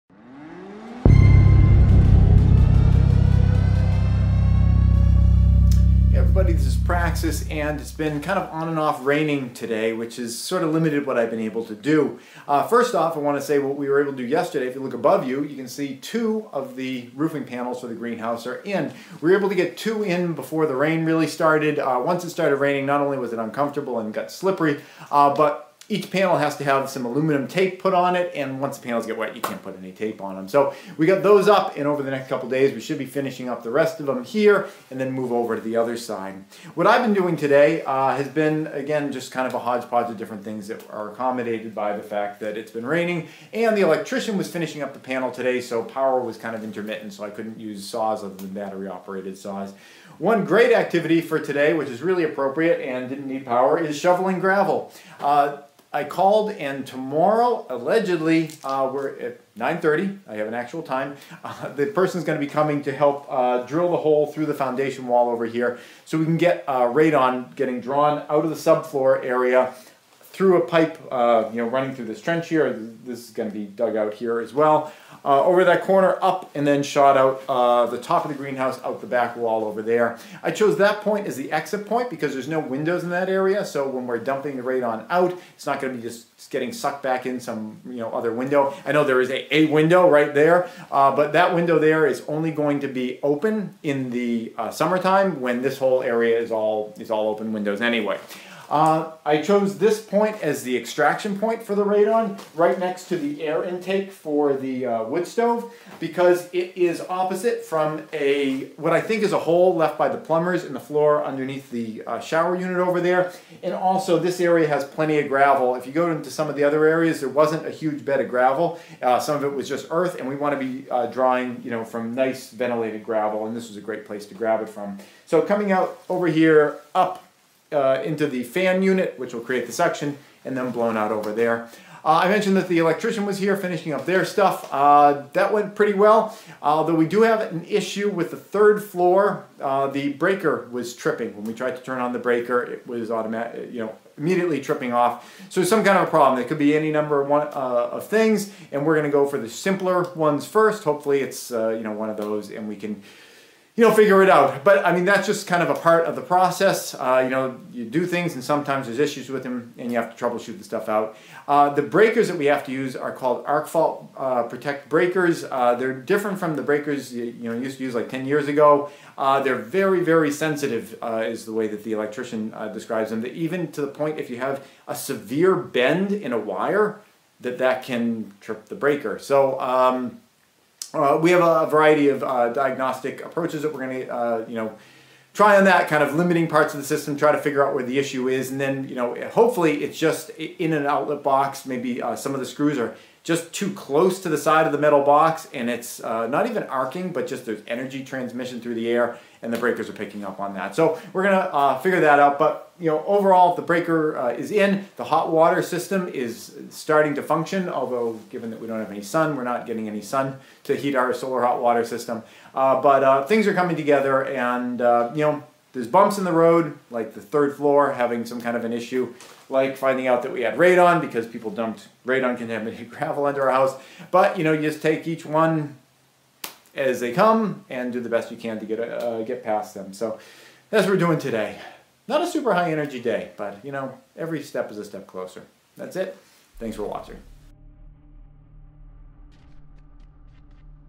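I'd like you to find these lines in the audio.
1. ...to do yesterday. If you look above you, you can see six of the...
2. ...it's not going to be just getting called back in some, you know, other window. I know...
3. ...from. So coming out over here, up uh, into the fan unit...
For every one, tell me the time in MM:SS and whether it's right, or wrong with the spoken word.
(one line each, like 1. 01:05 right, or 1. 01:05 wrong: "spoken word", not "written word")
1. 00:14 wrong: "two", not "six"
2. 01:25 wrong: "sucked", not "called"
3. 02:04 right.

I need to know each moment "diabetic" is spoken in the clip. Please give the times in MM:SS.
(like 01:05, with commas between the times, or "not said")
not said.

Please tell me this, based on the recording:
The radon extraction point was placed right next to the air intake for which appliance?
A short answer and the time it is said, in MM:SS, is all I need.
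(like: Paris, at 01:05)
wood stove, at 01:45.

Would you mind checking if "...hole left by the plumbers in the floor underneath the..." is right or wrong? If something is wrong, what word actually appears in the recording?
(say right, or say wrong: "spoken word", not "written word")
right.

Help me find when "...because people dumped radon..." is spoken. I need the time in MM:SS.
03:40.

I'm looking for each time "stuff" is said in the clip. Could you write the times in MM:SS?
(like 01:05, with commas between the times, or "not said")
02:14, 02:40.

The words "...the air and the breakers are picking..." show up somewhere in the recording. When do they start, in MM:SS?
03:18.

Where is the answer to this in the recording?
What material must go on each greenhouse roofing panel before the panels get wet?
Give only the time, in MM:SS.
00:27.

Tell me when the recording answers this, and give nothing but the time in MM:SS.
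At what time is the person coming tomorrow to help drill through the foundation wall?
00:59.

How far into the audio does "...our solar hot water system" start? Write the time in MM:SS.
03:30.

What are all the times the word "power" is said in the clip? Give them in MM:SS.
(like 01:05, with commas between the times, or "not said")
00:45, 00:53.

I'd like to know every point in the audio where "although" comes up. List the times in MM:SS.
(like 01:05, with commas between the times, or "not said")
02:16, 03:27.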